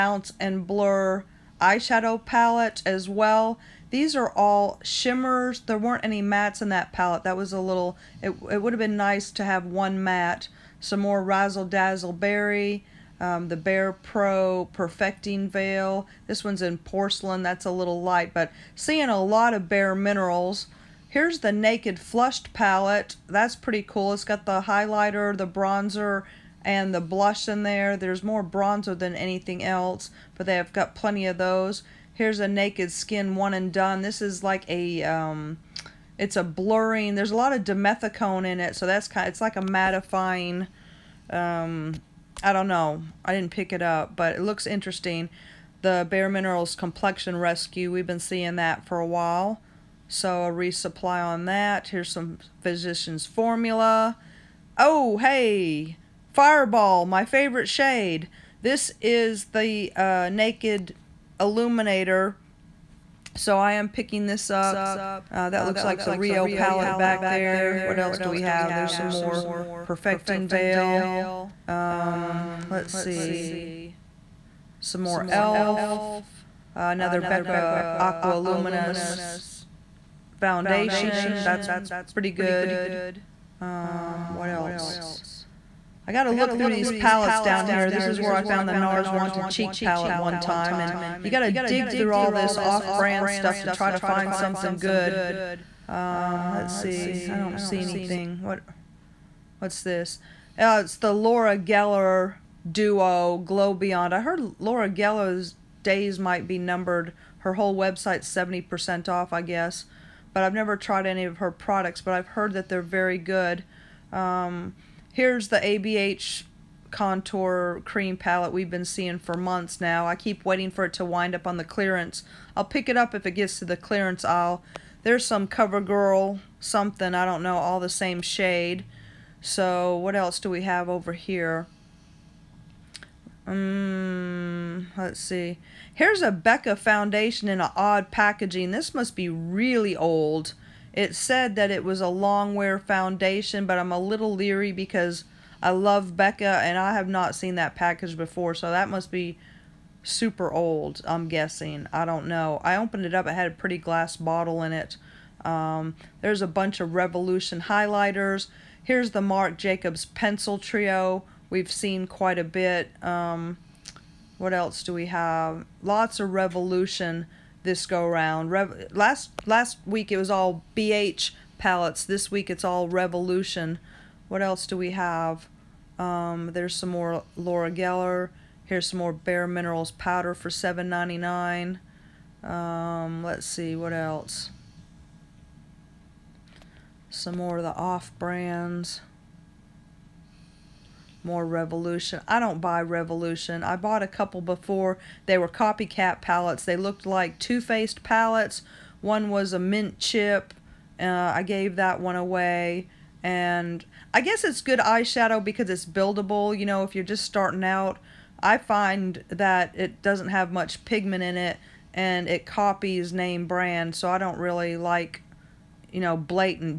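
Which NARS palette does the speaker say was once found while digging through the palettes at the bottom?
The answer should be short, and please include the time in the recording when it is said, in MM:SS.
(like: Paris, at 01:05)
Wanted Cheek, at 01:29.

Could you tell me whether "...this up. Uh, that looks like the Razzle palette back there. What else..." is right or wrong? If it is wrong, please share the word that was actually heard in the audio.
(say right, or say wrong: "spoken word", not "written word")
wrong: "Rio", not "Razzle".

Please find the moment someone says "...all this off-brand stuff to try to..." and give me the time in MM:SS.
01:32.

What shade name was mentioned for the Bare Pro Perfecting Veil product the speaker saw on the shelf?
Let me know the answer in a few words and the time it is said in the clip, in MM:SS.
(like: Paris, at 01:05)
Porcelain, at 00:16.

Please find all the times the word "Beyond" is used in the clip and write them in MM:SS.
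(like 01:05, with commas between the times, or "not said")
01:43.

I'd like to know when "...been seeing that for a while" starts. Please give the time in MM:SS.
00:48.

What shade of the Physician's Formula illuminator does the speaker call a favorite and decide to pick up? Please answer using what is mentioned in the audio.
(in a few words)
Fireball.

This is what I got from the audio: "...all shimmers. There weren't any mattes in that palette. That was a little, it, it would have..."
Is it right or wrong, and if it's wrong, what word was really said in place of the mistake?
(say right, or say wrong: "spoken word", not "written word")
right.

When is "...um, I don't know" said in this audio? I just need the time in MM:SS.
00:41.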